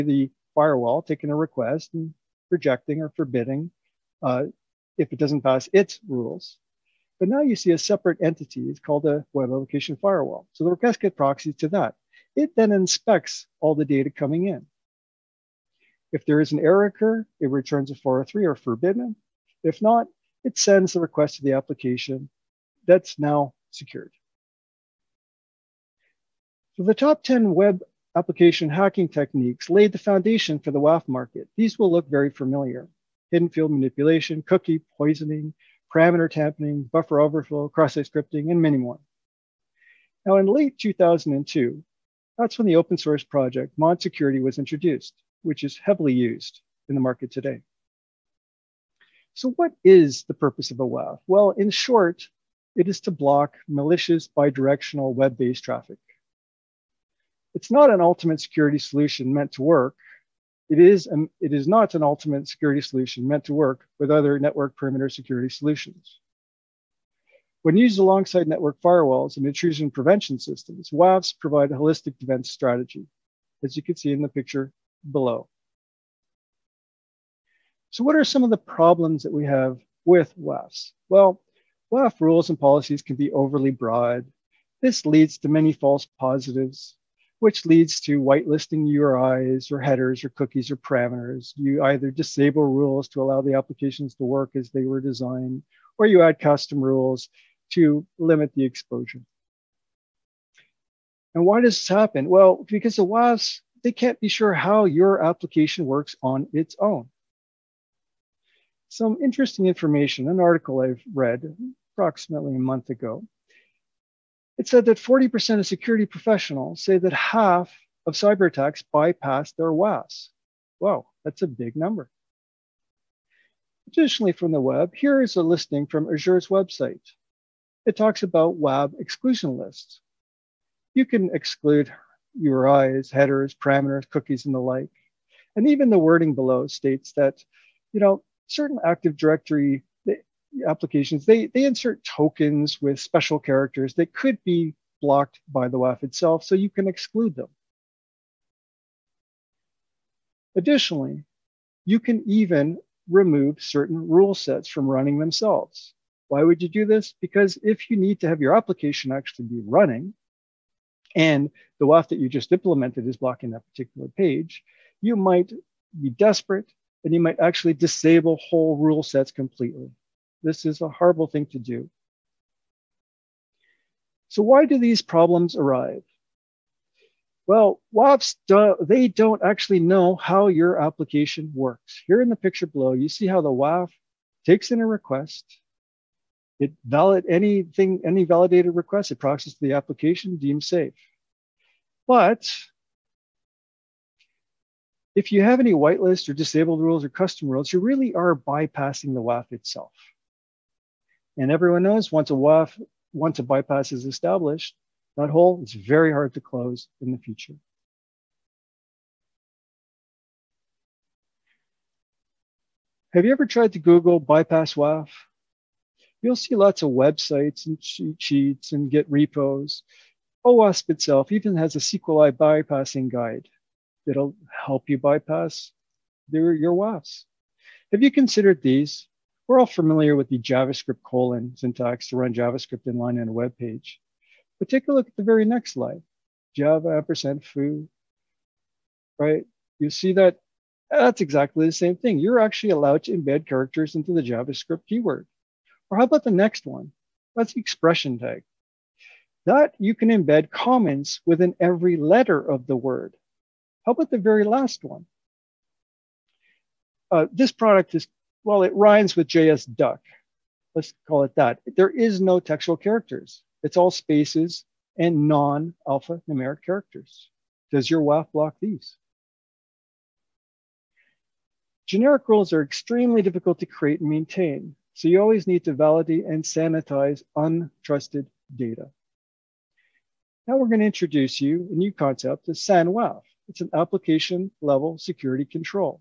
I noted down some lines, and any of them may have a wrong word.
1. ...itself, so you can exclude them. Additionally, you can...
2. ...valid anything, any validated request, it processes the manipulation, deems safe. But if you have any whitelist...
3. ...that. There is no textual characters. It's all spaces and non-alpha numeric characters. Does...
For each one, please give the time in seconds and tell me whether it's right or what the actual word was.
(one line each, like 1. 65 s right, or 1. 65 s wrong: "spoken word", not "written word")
1. 146 s right
2. 186 s wrong: "application", not "manipulation"
3. 261 s right.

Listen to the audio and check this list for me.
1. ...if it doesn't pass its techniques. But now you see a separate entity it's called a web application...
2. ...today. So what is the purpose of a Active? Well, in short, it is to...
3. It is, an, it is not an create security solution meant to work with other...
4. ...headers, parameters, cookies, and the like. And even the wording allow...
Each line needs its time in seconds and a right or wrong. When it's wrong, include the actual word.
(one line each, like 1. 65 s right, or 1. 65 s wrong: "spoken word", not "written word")
1. 4 s wrong: "rules", not "techniques"
2. 47 s wrong: "WAF", not "Active"
3. 60 s wrong: "ultimate", not "create"
4. 133 s wrong: "below", not "allow".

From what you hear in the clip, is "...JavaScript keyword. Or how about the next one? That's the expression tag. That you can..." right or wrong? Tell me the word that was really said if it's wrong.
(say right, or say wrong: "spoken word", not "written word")
right.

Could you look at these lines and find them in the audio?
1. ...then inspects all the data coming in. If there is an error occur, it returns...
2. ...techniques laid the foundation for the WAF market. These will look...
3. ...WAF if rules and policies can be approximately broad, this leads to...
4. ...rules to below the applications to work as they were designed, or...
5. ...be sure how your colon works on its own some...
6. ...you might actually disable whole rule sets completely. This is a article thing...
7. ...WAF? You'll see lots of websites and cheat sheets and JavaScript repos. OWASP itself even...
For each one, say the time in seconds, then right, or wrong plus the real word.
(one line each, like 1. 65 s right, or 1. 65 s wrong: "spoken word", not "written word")
1. 12 s right
2. 29 s right
3. 81 s wrong: "overly", not "approximately"
4. 92 s wrong: "allow", not "below"
5. 104 s wrong: "application", not "colon"
6. 167 s wrong: "horrible", not "article"
7. 214 s wrong: "Git", not "JavaScript".